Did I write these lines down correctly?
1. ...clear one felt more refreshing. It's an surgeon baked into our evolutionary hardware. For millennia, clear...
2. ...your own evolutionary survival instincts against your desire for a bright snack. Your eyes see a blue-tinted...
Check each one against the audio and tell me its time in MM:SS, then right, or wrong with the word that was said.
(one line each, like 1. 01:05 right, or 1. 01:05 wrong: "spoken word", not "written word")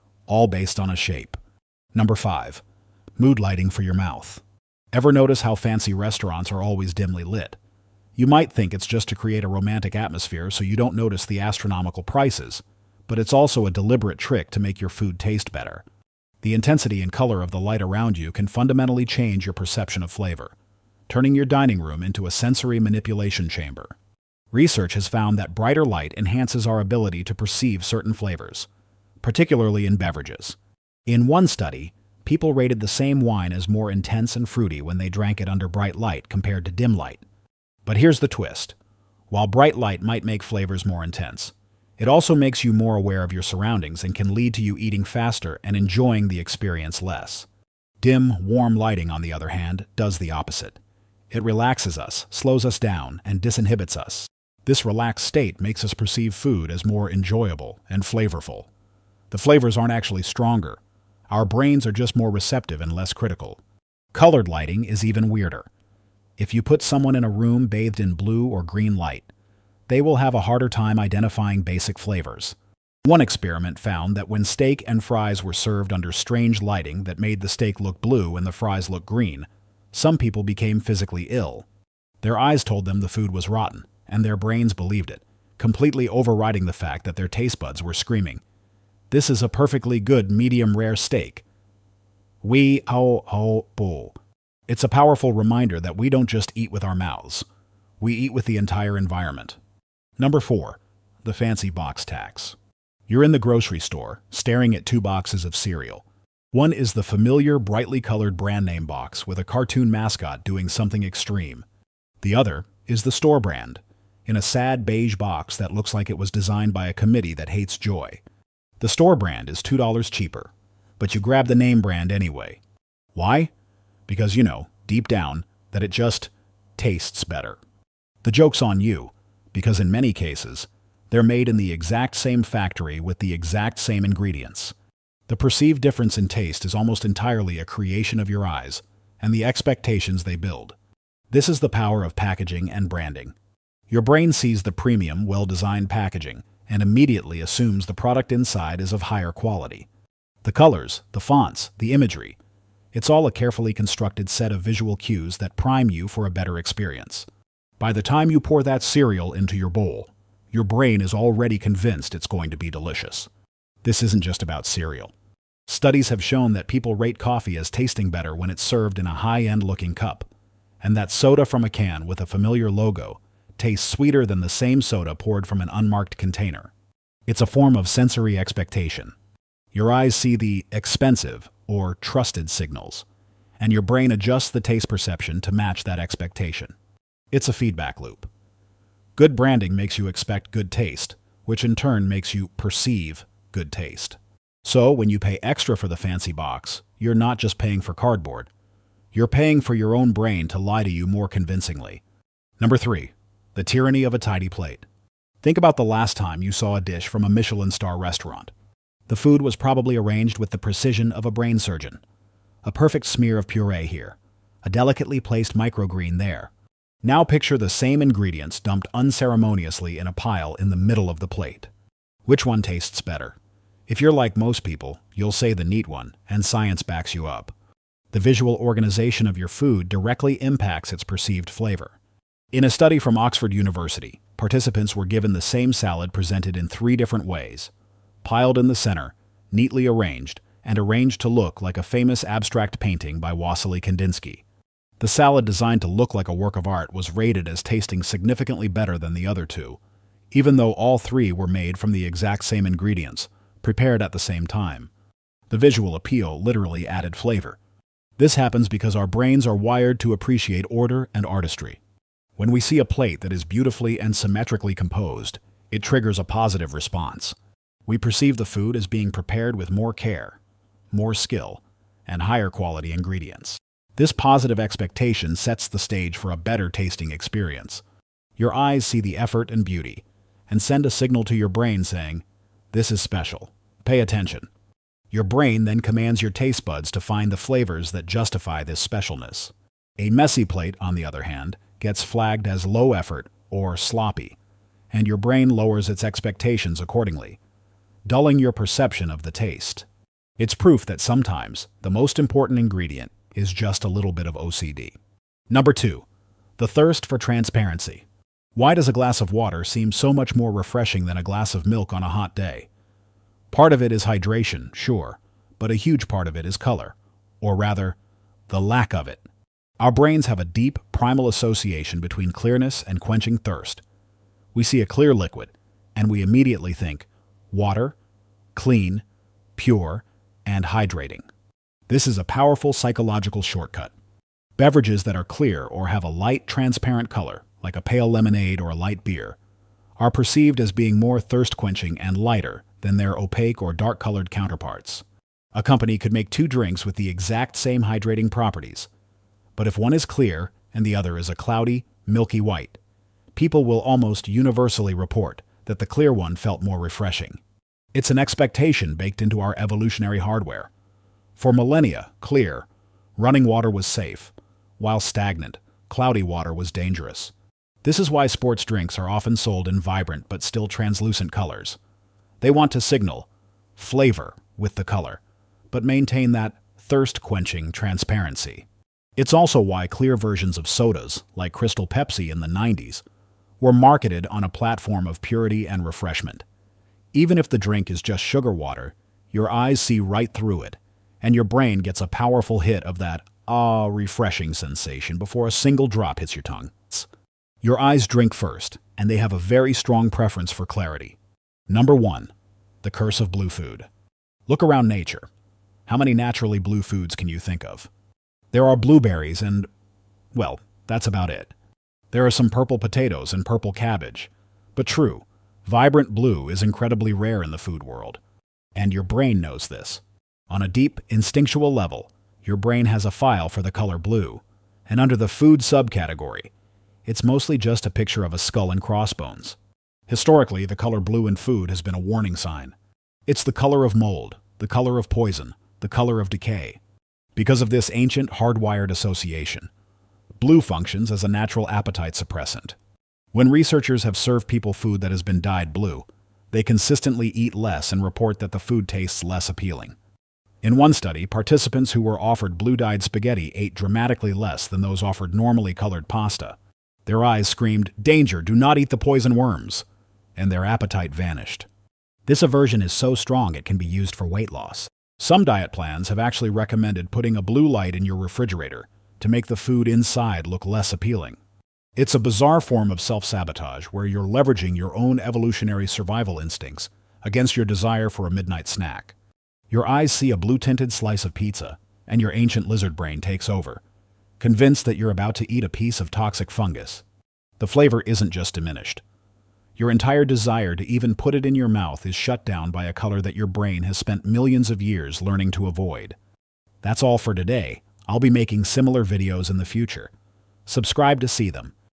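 1. 05:55 wrong: "expectation", not "surgeon"
2. 07:54 wrong: "midnight", not "bright".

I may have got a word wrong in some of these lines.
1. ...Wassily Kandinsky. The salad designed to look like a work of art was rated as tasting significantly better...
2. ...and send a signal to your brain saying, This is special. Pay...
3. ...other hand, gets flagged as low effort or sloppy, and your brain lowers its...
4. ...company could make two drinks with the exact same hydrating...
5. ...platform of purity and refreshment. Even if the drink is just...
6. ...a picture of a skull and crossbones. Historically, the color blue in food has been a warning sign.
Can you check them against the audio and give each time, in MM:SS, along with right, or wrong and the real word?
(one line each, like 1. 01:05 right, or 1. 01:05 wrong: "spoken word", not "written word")
1. 04:03 right
2. 04:40 right
3. 04:51 right
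4. 05:45 right
5. 06:24 right
6. 07:07 right.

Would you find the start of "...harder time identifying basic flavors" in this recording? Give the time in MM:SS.
01:10.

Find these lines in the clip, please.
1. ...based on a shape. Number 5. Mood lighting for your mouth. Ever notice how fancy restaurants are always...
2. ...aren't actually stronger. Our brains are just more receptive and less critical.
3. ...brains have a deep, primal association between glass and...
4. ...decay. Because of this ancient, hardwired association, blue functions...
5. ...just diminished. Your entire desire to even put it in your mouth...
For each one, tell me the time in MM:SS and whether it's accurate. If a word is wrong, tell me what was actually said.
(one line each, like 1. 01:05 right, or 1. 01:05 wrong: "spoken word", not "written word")
1. 00:00 right
2. 00:59 right
3. 05:19 wrong: "clearness", not "glass"
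4. 07:16 right
5. 08:08 right.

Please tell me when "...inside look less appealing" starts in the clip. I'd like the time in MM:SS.
07:49.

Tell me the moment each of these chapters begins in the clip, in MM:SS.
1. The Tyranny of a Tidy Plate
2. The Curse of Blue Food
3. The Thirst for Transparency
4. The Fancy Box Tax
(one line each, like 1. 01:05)
1. 03:22
2. 06:41
3. 05:05
4. 01:39.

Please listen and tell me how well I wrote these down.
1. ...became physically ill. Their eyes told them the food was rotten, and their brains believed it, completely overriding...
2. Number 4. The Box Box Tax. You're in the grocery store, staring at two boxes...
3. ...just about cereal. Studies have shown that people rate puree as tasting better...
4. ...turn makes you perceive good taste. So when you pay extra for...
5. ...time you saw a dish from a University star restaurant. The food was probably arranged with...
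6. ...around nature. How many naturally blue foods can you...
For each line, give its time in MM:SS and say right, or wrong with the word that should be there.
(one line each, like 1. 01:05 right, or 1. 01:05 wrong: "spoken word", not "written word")
1. 01:20 right
2. 01:40 wrong: "Fancy", not "Box"
3. 02:44 wrong: "coffee", not "puree"
4. 03:11 right
5. 03:26 wrong: "Michelin", not "University"
6. 06:44 right.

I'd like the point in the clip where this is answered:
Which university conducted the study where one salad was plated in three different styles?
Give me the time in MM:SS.
03:53.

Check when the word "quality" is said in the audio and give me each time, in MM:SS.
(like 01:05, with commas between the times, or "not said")
02:29, 04:32.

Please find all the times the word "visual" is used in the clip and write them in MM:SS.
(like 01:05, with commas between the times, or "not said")
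02:34, 03:48, 04:15.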